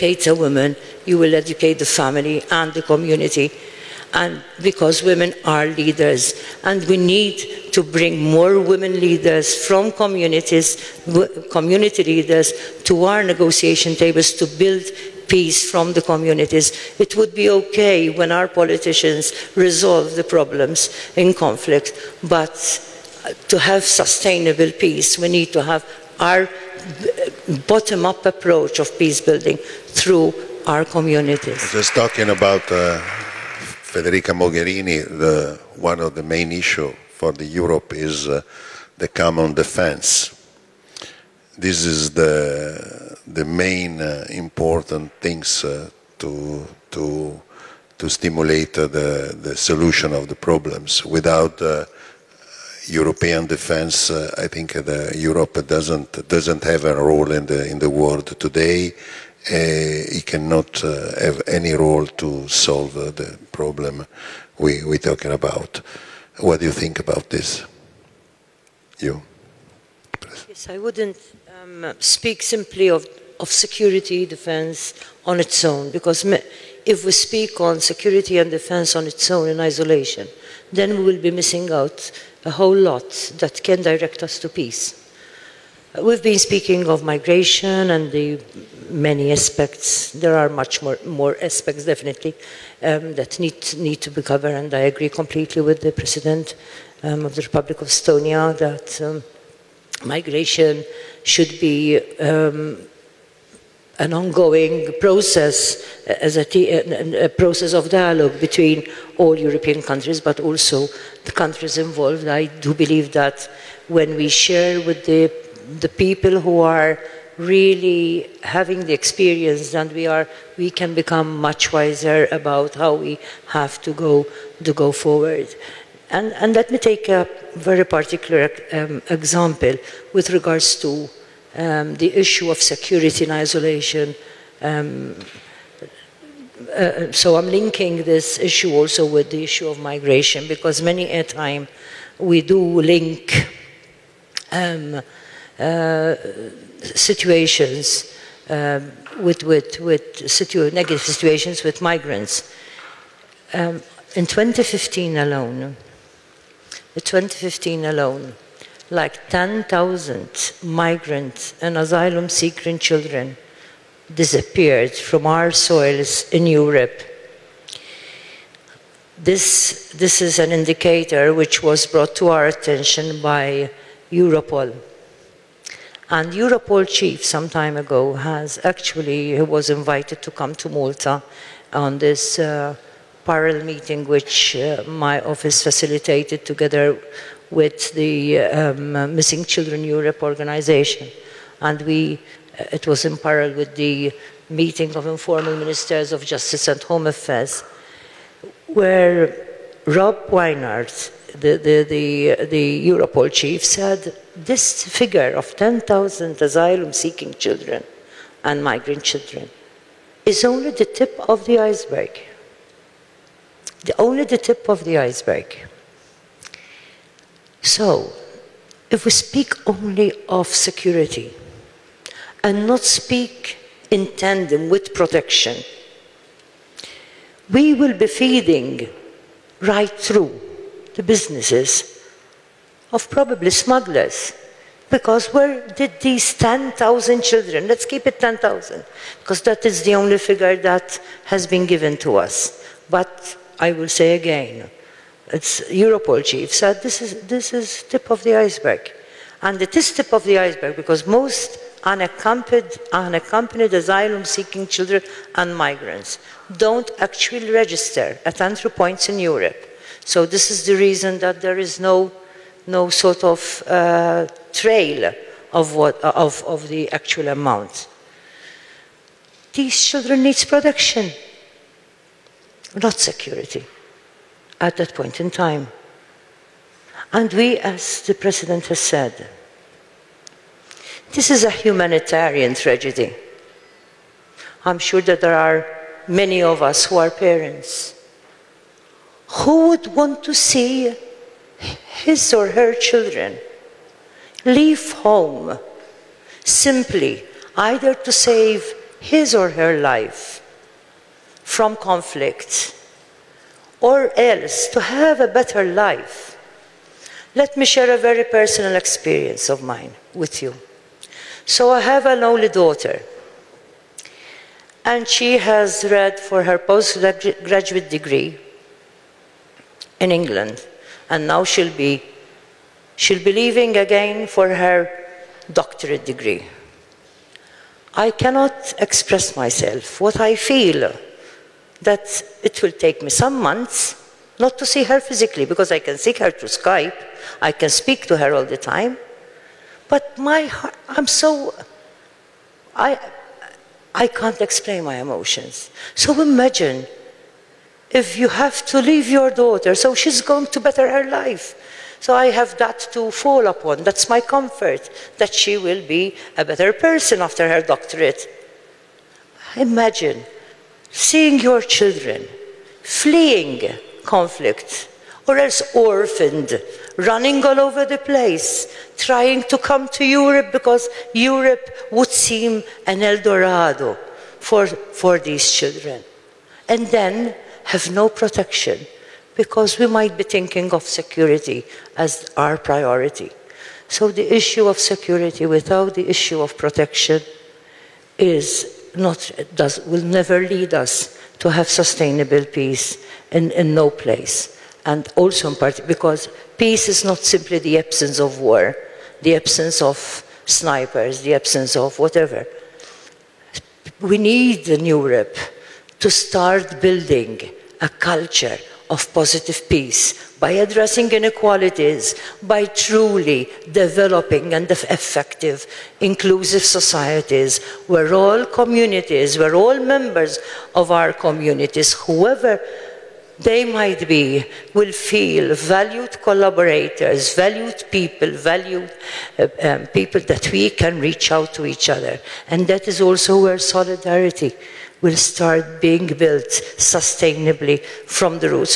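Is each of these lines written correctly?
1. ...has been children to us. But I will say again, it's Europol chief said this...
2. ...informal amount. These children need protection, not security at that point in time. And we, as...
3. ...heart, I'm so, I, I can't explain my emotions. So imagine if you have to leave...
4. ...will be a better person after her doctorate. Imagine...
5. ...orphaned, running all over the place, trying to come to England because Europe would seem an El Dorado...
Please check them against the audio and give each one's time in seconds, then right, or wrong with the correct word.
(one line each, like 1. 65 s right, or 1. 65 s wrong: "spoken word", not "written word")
1. 241 s wrong: "given", not "children"
2. 266 s wrong: "actual", not "informal"
3. 340 s right
4. 355 s right
5. 365 s wrong: "Europe", not "England".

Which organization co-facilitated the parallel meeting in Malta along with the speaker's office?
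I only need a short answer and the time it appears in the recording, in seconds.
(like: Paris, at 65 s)
Missing Children Europe, at 189 s.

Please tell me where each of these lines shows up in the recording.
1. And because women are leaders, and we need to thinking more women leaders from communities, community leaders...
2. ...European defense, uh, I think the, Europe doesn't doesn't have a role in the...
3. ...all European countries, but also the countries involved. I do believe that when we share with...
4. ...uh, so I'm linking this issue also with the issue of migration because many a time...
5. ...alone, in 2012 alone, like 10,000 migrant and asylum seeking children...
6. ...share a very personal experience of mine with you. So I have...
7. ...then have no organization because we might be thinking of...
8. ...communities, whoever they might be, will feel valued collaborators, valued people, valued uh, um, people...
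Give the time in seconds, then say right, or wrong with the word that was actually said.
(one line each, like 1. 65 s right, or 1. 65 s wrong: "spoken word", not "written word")
1. 4 s wrong: "bring", not "thinking"
2. 52 s right
3. 109 s right
4. 136 s right
5. 155 s wrong: "2015", not "2012"
6. 307 s right
7. 376 s wrong: "protection", not "organization"
8. 421 s right.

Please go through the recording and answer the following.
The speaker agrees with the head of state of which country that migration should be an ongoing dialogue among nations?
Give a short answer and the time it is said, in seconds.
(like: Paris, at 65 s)
Estonia, at 97 s.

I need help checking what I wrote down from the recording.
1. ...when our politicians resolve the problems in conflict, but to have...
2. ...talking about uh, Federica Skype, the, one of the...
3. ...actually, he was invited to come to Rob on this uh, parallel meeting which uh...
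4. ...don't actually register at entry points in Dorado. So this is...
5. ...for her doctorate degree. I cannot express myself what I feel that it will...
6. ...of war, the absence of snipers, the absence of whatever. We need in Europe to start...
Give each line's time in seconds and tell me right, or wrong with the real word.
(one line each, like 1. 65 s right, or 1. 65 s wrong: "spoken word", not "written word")
1. 18 s right
2. 31 s wrong: "Mogherini", not "Skype"
3. 178 s wrong: "Malta", not "Rob"
4. 256 s wrong: "Europe", not "Dorado"
5. 324 s right
6. 398 s right.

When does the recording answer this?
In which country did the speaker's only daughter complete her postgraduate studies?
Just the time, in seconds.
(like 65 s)
320 s.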